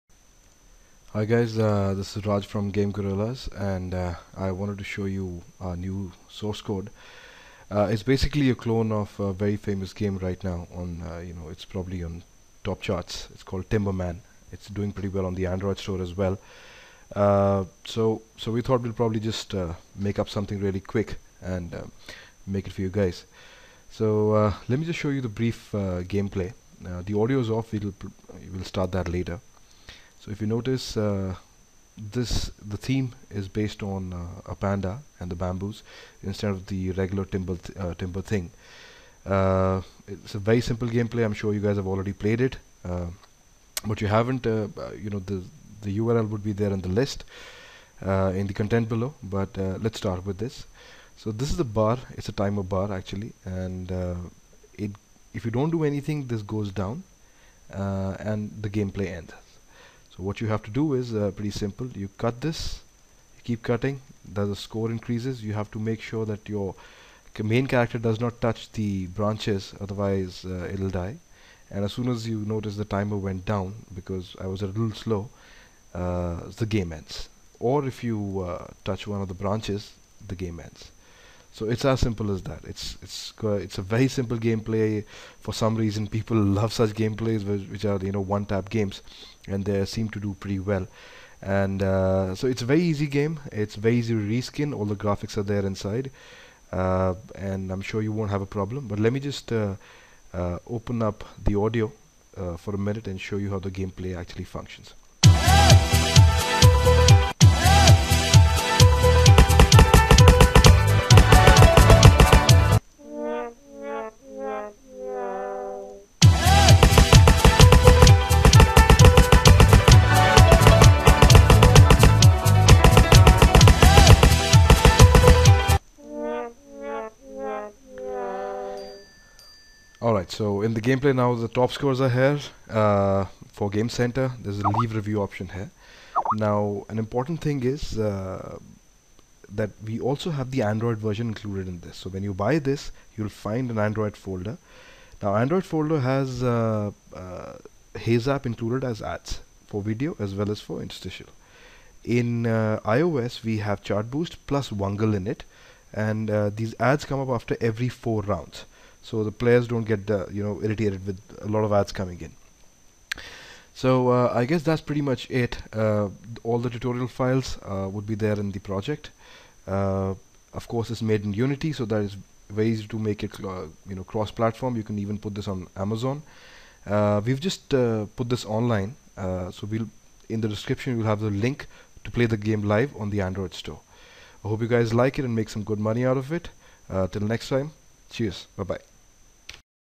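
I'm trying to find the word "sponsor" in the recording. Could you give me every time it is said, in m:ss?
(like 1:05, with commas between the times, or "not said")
not said.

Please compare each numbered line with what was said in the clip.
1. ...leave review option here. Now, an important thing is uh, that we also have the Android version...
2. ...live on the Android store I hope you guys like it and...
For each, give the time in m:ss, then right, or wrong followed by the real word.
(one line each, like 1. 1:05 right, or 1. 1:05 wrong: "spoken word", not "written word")
1. 2:14 right
2. 3:02 right.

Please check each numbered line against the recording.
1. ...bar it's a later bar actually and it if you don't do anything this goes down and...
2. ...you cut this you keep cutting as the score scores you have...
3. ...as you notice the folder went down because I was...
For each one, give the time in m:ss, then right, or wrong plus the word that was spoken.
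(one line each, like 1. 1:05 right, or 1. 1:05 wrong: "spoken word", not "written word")
1. 0:51 wrong: "timer", not "later"
2. 1:01 wrong: "increases", not "scores"
3. 1:12 wrong: "timer", not "folder".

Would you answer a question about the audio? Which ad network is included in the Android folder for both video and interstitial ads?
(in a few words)
Heyzap.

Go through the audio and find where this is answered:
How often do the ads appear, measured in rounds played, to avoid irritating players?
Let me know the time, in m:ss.
2:37.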